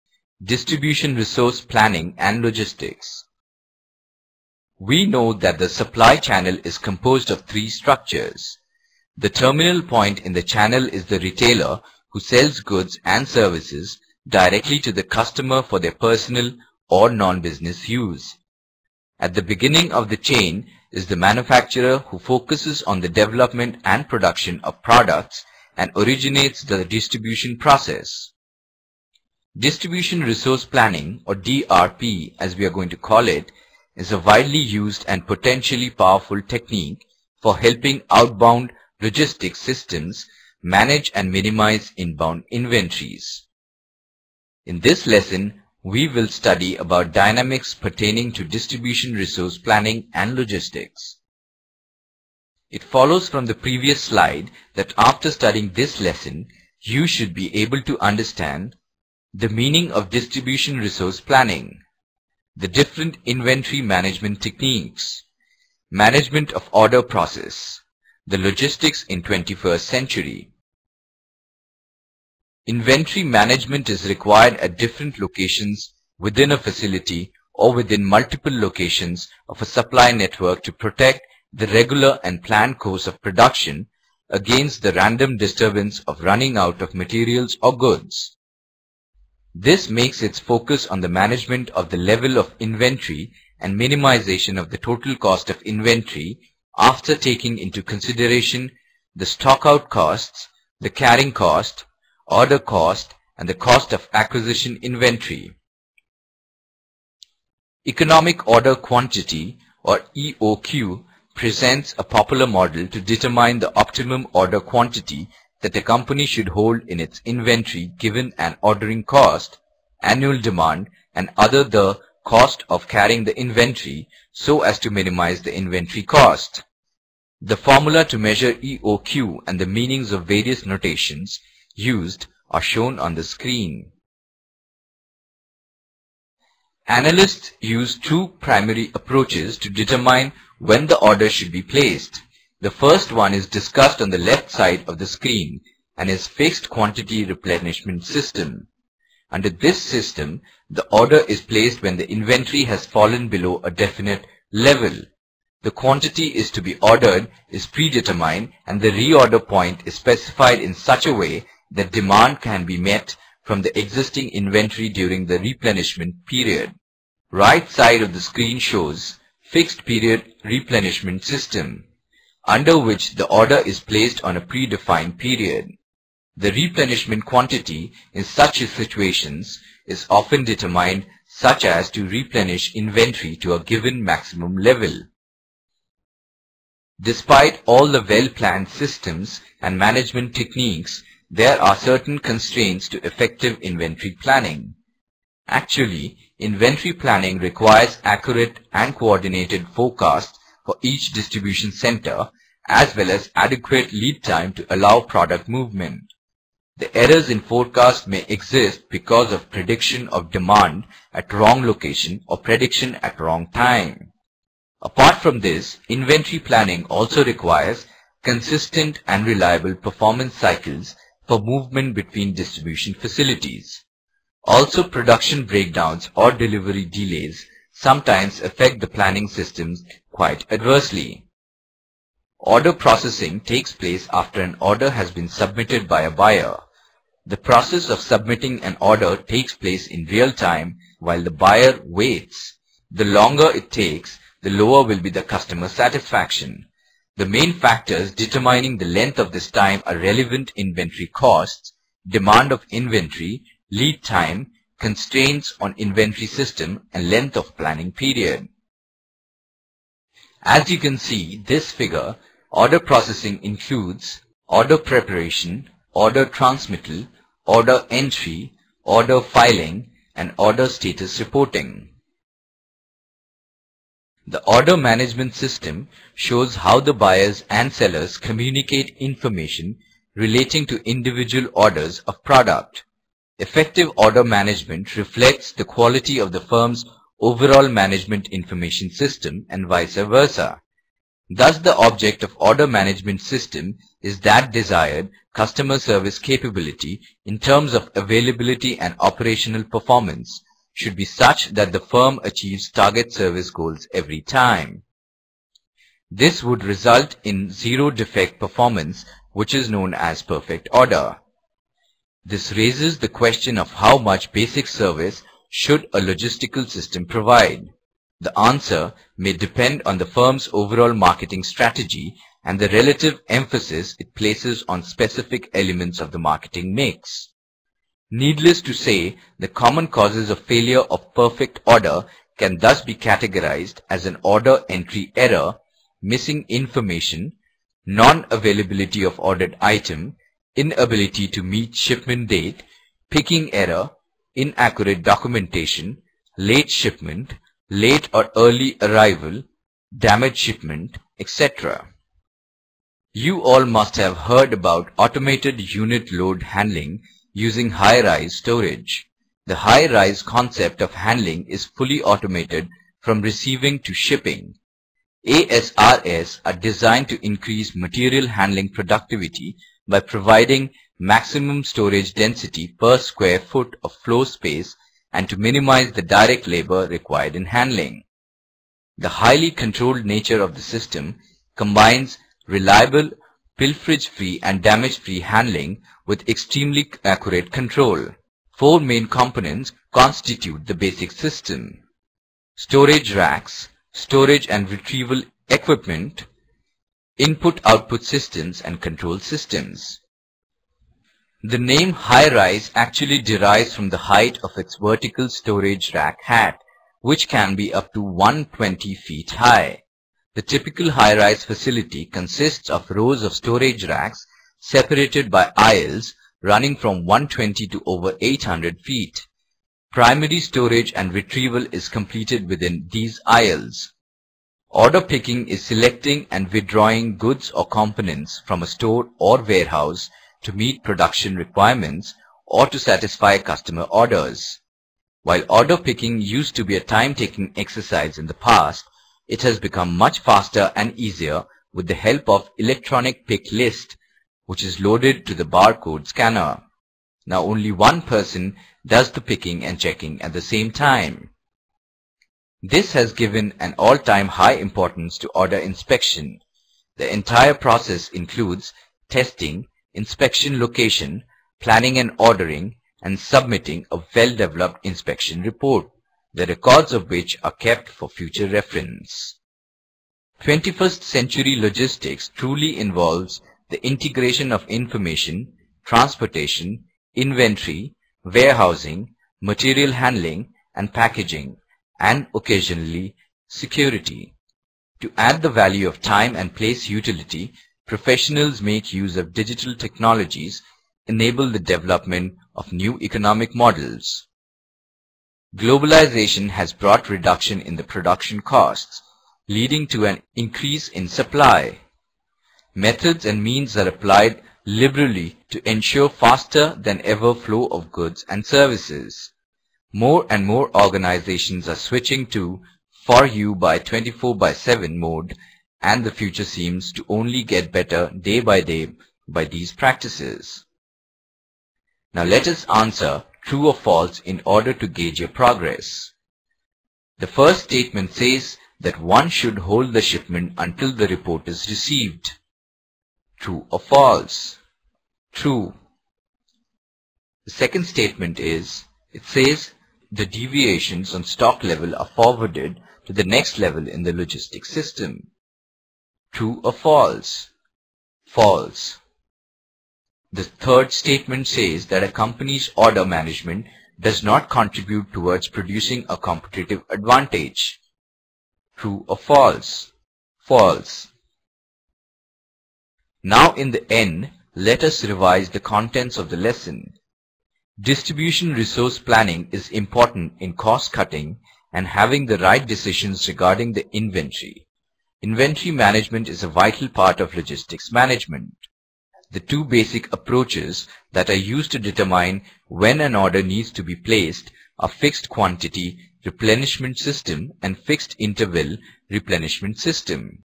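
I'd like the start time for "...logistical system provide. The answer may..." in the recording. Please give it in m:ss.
5:15.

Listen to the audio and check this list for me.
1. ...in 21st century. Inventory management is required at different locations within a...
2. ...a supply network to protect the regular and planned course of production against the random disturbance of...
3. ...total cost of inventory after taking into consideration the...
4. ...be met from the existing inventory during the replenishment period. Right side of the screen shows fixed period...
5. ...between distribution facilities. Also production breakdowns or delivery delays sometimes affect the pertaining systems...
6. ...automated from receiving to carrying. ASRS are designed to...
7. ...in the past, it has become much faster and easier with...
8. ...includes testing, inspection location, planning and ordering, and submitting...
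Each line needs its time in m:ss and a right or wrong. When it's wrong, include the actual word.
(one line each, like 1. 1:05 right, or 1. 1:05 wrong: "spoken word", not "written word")
1. 1:09 right
2. 1:19 right
3. 1:34 right
4. 2:42 right
5. 3:41 wrong: "planning", not "pertaining"
6. 6:02 wrong: "shipping", not "carrying"
7. 7:18 right
8. 7:38 right.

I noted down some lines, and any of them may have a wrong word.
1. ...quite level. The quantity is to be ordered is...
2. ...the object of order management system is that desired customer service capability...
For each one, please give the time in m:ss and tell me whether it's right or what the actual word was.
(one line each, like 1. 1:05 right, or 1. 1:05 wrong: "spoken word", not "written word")
1. 2:33 wrong: "definite", not "quite"
2. 4:51 right.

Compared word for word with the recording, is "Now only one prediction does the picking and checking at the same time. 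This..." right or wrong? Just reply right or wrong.
wrong.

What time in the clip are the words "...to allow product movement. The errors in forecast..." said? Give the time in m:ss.
3:24.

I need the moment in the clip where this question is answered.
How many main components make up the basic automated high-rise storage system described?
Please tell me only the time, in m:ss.
6:28.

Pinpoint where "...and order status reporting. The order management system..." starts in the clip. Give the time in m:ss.
4:30.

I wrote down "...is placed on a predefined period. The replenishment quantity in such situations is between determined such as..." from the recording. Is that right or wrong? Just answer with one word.
wrong.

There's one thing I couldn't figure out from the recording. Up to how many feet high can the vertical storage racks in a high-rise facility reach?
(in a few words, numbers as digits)
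120 feet.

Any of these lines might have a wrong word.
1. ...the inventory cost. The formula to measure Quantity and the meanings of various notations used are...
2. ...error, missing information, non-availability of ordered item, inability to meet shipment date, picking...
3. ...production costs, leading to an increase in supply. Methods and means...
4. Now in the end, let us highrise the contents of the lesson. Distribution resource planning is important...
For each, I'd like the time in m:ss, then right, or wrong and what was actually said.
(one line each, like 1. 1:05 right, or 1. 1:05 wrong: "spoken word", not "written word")
1. 2:05 wrong: "EOQ", not "Quantity"
2. 5:35 right
3. 8:17 right
4. 9:23 wrong: "revise", not "highrise".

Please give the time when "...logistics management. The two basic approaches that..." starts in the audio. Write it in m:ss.
9:37.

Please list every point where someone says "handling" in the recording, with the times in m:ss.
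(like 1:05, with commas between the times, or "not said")
5:56, 6:00, 6:08, 6:17, 6:25, 7:59.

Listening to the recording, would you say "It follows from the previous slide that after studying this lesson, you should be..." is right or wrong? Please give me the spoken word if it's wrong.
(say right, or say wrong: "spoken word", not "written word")
right.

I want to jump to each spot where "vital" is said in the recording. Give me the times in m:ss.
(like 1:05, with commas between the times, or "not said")
9:36.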